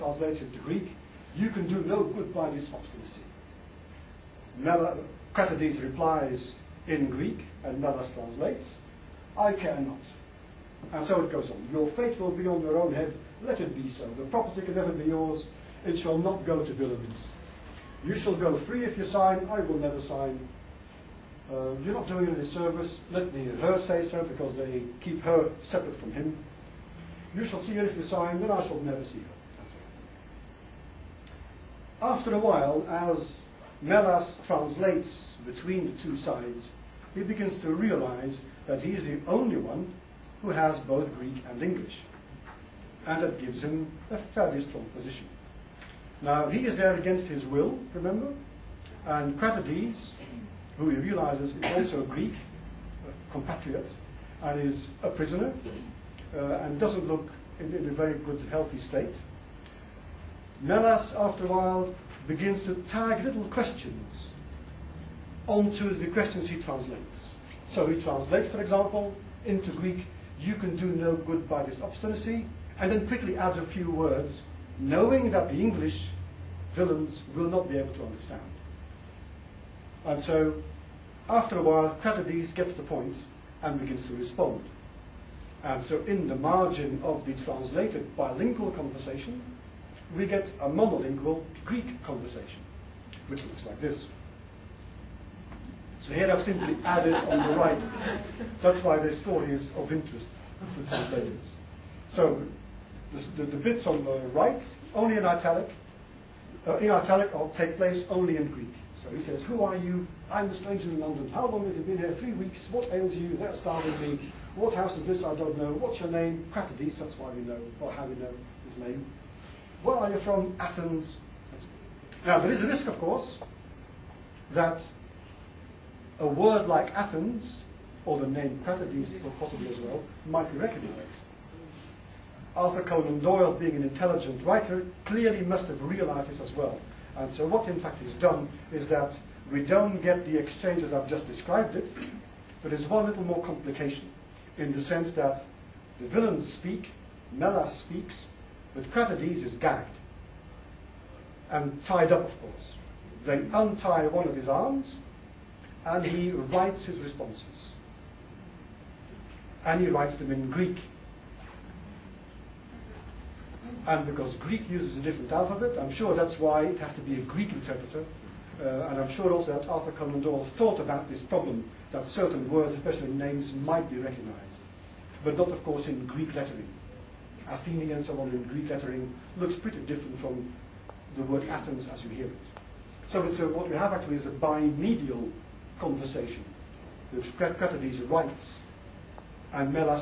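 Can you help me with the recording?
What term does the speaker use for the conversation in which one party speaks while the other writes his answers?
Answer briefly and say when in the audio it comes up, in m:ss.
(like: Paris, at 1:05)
bimedial conversation, at 3:04.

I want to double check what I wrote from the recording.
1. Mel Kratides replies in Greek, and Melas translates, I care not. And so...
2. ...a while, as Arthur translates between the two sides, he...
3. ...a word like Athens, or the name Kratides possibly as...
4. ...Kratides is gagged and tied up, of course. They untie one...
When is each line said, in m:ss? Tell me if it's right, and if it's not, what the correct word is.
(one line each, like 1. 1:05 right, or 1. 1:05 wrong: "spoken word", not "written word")
1. 0:04 right
2. 0:32 wrong: "Melas", not "Arthur"
3. 2:06 right
4. 2:28 right.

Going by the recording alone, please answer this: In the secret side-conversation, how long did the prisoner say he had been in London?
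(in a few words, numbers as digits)
3 weeks.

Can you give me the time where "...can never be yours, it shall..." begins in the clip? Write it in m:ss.
0:14.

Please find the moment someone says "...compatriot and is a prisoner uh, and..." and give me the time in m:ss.
0:53.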